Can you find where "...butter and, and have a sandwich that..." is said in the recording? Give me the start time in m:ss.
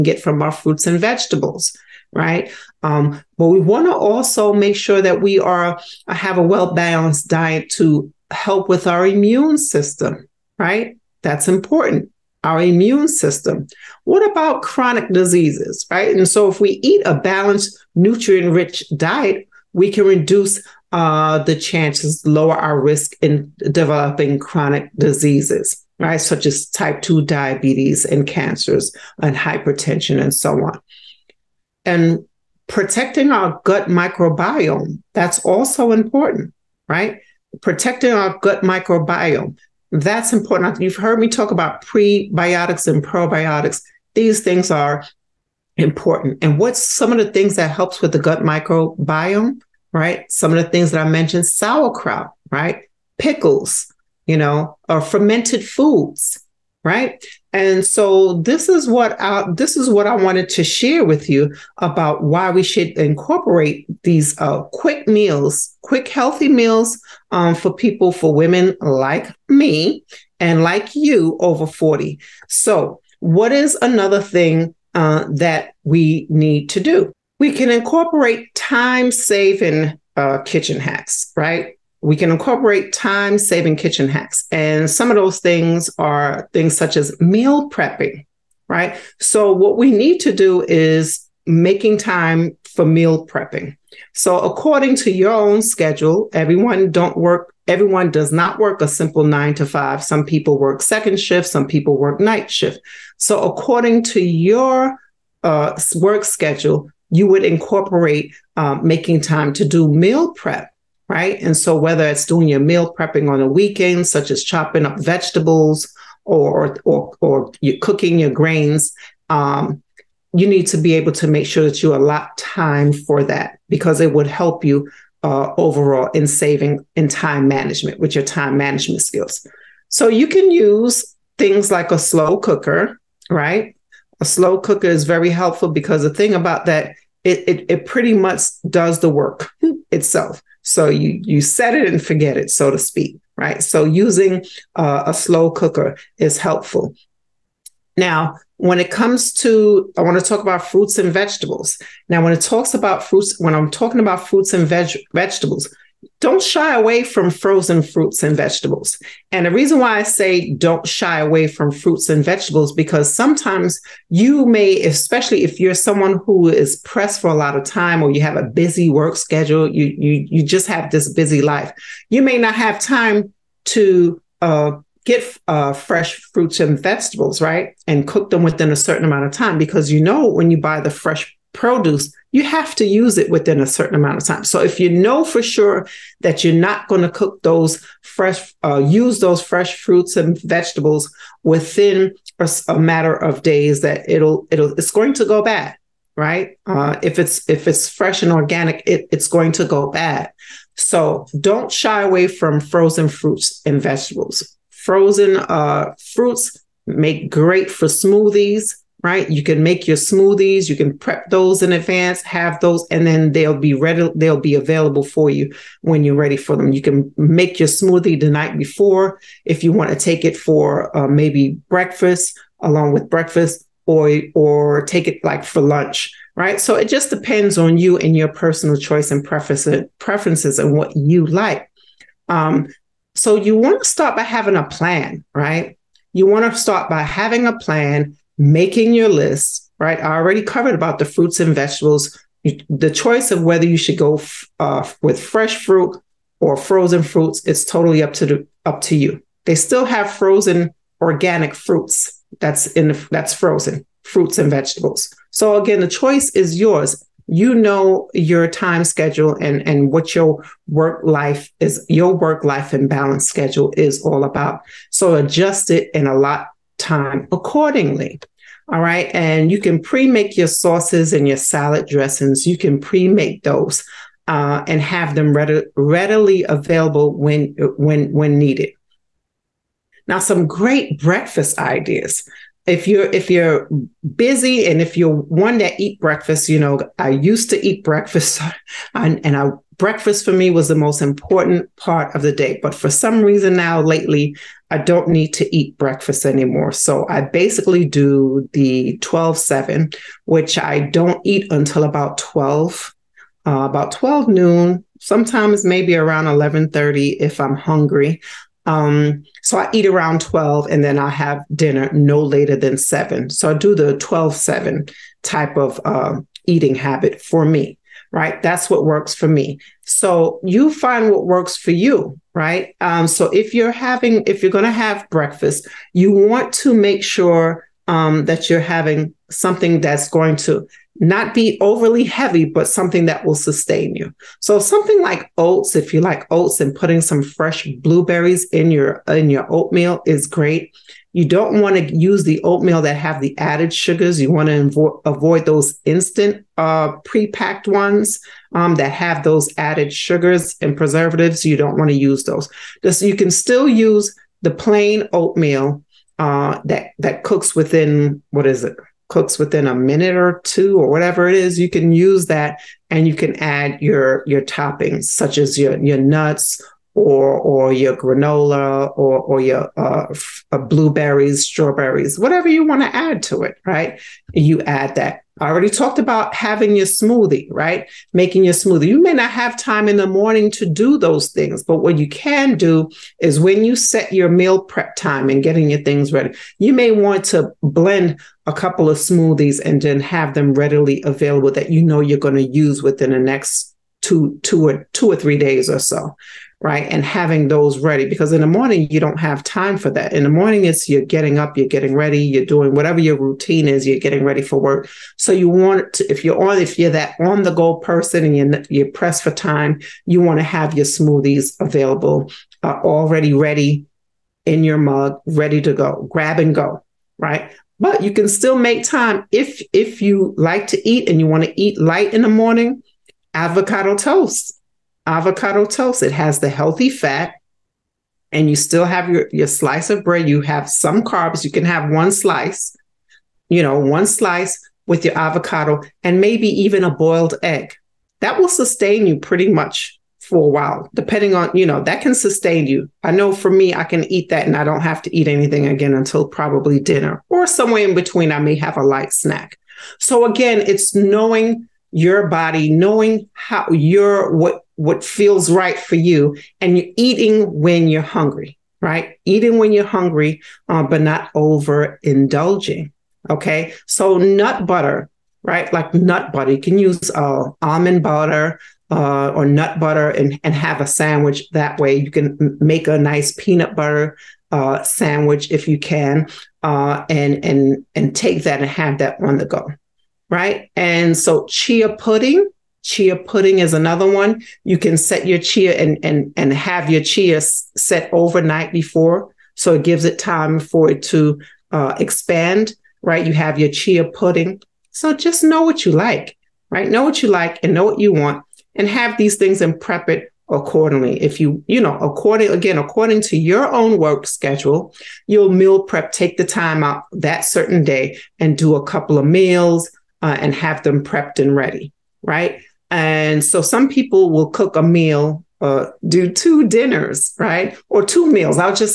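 7:49.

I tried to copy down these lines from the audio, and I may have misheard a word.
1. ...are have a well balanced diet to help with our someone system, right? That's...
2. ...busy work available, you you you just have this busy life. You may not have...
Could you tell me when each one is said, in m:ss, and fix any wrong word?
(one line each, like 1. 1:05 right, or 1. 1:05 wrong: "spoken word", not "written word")
1. 0:05 wrong: "immune", not "someone"
2. 2:48 wrong: "schedule", not "available".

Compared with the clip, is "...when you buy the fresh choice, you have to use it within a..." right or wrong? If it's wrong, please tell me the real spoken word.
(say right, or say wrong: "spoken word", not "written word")
wrong: "produce", not "choice".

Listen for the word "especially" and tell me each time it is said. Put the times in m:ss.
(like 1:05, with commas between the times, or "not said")
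2:44.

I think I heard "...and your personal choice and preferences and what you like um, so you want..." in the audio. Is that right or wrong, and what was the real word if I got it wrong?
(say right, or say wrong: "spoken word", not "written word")
right.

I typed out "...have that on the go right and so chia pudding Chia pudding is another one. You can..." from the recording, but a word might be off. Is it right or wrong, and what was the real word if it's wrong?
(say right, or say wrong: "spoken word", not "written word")
right.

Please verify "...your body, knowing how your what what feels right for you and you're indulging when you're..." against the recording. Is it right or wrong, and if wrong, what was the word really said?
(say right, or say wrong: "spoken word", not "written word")
wrong: "eating", not "indulging".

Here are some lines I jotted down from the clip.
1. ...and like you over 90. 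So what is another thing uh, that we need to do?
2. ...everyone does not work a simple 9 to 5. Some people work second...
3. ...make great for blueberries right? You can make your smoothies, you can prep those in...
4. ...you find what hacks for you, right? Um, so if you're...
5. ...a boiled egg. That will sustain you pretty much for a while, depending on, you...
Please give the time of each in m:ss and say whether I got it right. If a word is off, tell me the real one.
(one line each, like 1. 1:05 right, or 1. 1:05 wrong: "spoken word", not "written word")
1. 1:10 wrong: "40", not "90"
2. 1:37 right
3. 3:26 wrong: "smoothies", not "blueberries"
4. 5:20 wrong: "works", not "hacks"
5. 7:16 right.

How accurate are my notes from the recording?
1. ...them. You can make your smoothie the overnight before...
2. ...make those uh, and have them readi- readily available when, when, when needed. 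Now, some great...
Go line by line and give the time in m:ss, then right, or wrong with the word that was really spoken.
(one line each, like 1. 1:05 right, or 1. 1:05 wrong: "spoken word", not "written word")
1. 3:36 wrong: "night", not "overnight"
2. 4:33 right.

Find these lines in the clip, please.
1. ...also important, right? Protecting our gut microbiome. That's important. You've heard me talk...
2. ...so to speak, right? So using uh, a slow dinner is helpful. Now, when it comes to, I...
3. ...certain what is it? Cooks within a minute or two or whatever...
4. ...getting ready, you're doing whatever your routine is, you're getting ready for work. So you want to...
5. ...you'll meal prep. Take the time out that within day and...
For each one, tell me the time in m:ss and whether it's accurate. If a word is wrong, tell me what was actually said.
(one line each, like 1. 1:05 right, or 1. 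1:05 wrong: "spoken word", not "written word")
1. 0:35 right
2. 2:22 wrong: "cooker", not "dinner"
3. 5:57 wrong: "within", not "certain"
4. 6:41 right
5. 8:25 wrong: "certain", not "within".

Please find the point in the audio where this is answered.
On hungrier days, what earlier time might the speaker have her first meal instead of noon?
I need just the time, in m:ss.
5:06.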